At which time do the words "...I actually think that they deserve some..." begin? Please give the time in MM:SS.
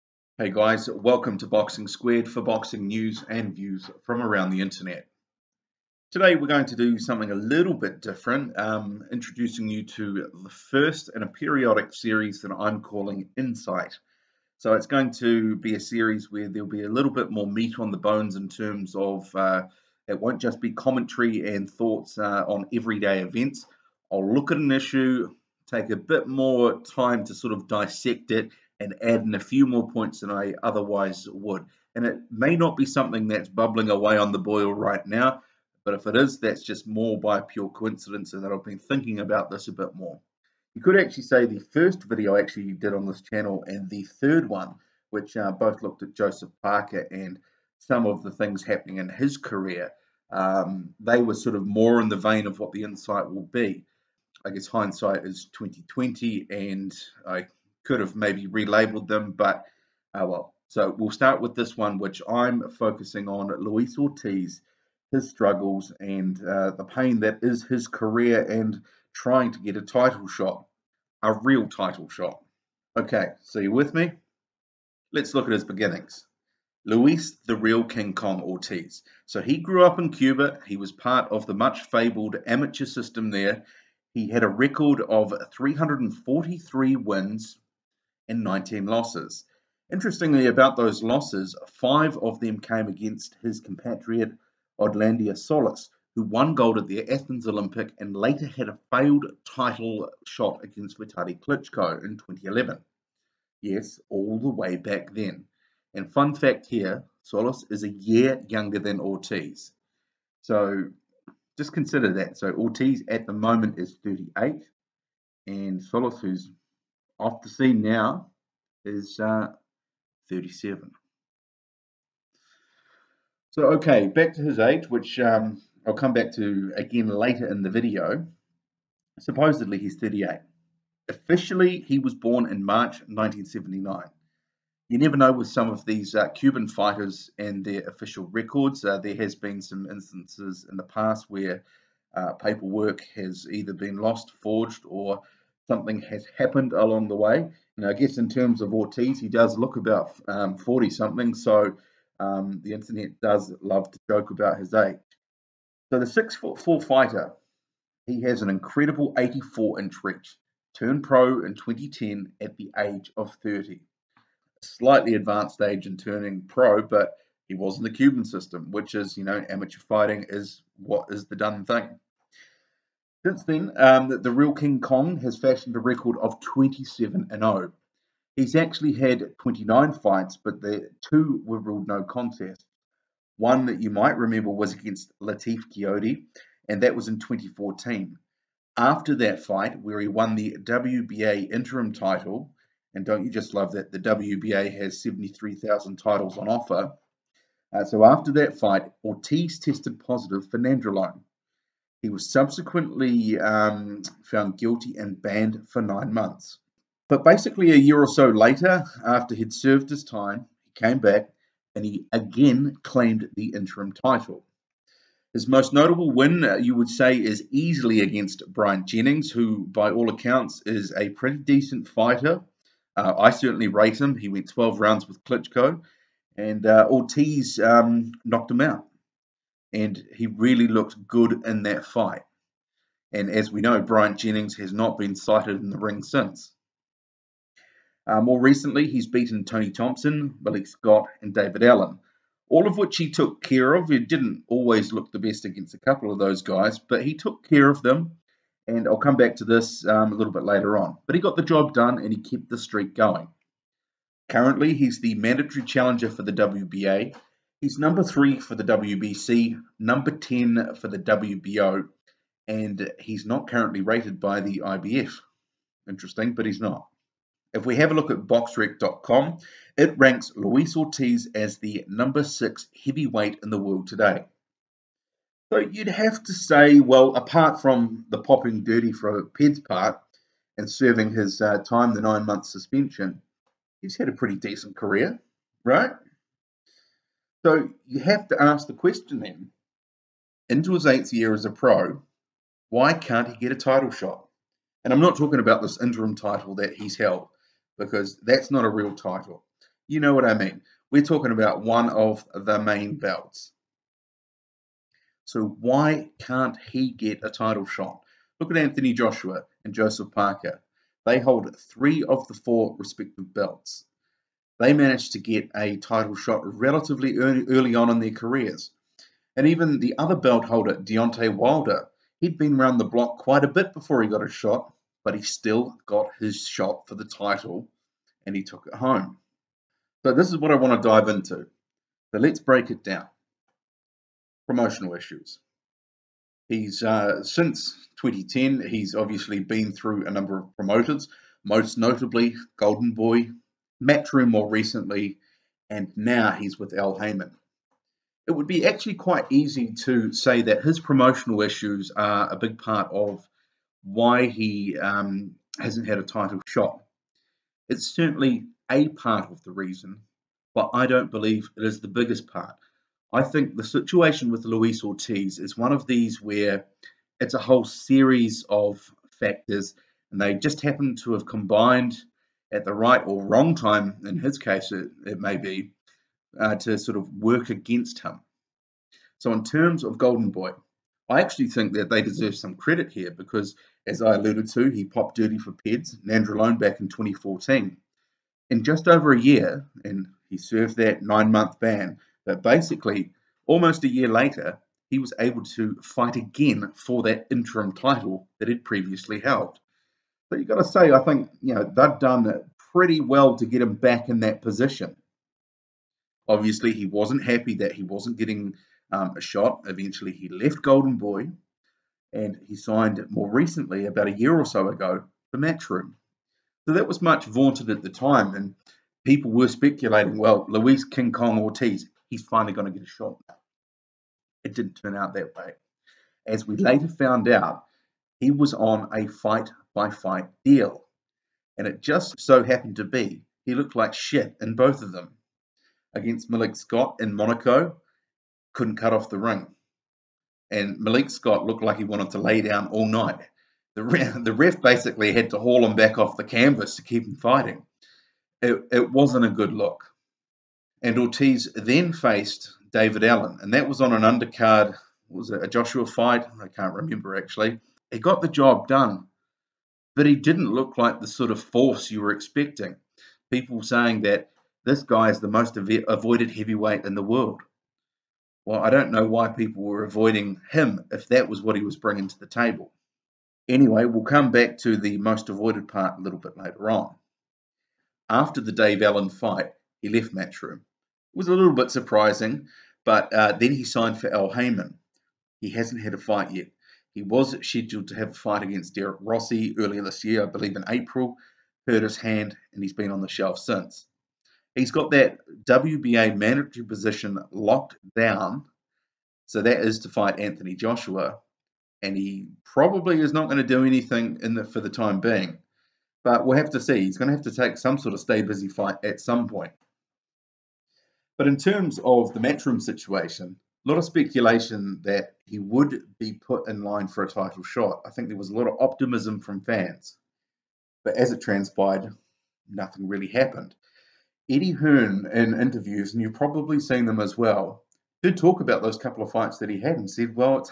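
06:21.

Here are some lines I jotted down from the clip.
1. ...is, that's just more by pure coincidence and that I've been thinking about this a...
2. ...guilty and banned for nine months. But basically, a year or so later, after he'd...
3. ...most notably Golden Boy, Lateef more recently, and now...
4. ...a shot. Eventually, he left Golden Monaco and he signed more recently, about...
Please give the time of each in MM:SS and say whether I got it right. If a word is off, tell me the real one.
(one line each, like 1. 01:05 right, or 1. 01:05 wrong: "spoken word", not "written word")
1. 00:36 right
2. 03:24 right
3. 05:41 wrong: "Matchroom", not "Lateef"
4. 06:49 wrong: "Boy", not "Monaco".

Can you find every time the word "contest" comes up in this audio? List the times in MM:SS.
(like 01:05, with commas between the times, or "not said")
03:02.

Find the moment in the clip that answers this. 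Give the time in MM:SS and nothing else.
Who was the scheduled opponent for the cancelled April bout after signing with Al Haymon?
08:08.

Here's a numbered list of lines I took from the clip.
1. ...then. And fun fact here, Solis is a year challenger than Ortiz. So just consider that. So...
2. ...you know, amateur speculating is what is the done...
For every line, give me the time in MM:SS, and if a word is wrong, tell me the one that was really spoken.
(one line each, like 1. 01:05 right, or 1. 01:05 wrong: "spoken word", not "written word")
1. 01:45 wrong: "younger", not "challenger"
2. 02:49 wrong: "fighting", not "speculating".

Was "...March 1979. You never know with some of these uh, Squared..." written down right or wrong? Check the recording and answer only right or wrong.
wrong.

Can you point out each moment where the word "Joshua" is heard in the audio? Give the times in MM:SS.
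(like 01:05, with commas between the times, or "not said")
05:08, 07:35, 08:20.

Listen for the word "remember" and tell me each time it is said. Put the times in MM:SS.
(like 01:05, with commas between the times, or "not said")
03:04, 07:36.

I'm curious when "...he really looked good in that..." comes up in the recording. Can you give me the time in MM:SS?
03:50.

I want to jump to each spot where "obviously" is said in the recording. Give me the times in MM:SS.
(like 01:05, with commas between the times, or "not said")
05:38, 06:46.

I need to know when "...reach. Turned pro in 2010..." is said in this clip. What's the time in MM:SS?
02:40.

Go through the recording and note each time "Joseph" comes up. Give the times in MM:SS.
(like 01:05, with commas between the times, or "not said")
00:46, 05:09.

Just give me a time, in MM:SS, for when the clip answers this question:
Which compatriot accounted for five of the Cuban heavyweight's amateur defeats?
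01:34.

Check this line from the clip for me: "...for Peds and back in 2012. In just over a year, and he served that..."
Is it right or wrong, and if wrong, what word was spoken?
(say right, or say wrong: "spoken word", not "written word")
wrong: "2014", not "2012".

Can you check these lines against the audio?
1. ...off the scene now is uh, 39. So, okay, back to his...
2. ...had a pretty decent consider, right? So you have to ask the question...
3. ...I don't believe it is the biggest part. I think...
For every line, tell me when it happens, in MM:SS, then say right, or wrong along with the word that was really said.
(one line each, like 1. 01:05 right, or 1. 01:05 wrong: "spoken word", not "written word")
1. 01:57 wrong: "37", not "39"
2. 04:43 wrong: "career", not "consider"
3. 06:00 right.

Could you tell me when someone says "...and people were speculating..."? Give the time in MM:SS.
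06:58.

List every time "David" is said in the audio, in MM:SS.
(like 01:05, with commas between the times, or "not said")
04:01, 07:32.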